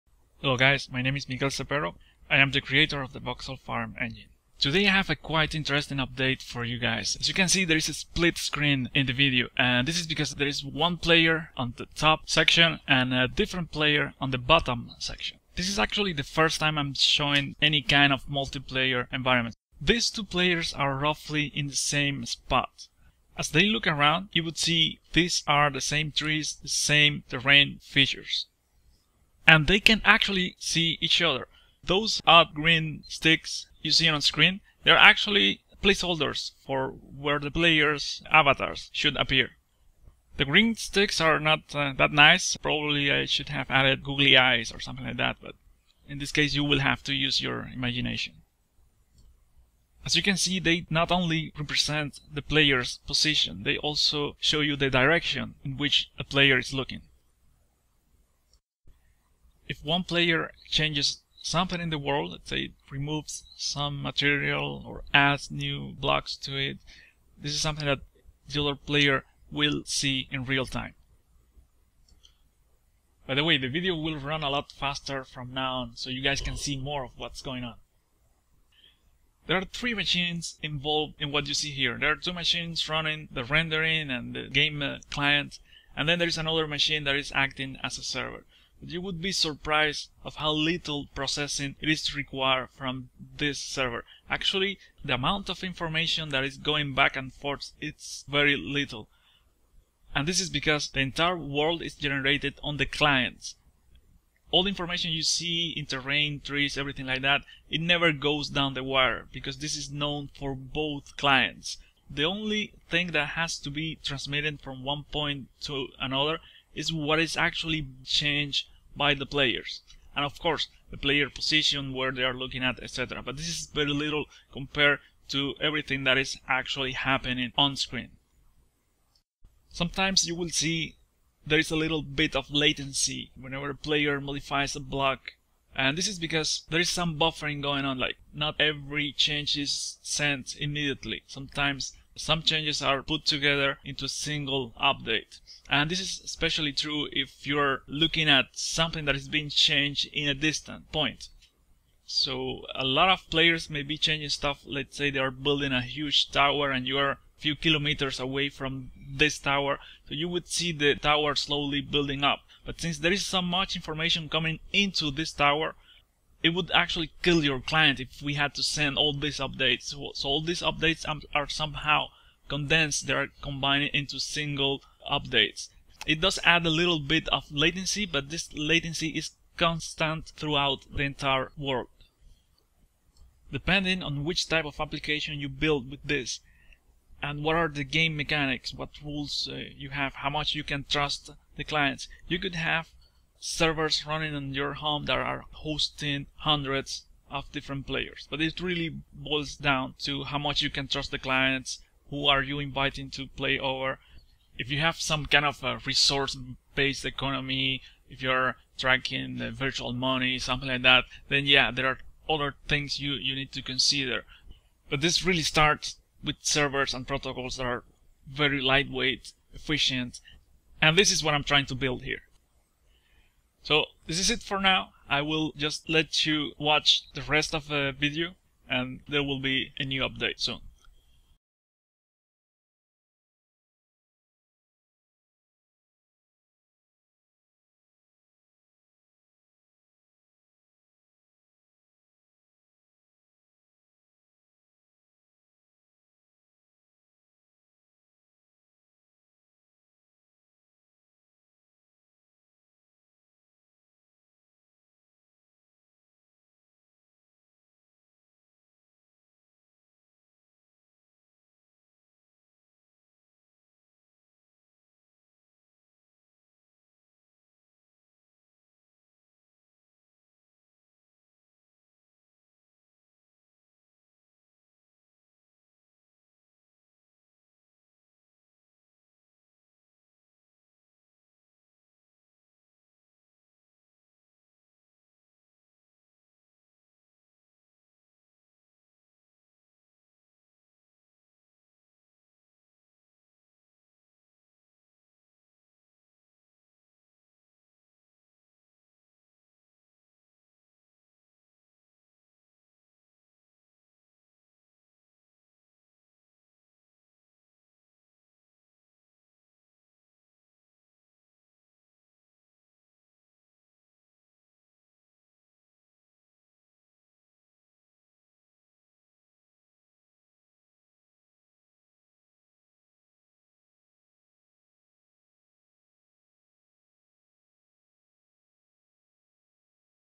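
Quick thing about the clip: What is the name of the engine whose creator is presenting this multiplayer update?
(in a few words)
Voxel Farm.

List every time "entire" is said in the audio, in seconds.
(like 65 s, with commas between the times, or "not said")
100 s, 181 s.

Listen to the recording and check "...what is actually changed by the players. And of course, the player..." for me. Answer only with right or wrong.
right.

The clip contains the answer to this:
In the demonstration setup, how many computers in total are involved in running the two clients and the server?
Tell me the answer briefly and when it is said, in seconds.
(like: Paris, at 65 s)
3, at 79 s.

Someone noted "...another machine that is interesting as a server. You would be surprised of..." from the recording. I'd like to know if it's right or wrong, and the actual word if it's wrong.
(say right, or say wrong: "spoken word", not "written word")
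wrong: "acting", not "interesting".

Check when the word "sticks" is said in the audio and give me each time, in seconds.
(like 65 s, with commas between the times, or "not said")
33 s, 40 s.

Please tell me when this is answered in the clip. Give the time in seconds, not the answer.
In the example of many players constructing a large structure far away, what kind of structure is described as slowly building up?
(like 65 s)
155 s.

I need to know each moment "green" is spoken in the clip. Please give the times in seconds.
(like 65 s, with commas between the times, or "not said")
32 s, 40 s.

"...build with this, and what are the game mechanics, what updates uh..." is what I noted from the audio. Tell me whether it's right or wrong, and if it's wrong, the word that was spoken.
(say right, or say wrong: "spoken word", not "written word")
wrong: "rules", not "updates".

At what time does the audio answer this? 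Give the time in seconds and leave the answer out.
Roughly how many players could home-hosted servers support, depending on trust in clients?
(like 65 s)
196 s.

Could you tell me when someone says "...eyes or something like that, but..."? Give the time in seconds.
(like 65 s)
44 s.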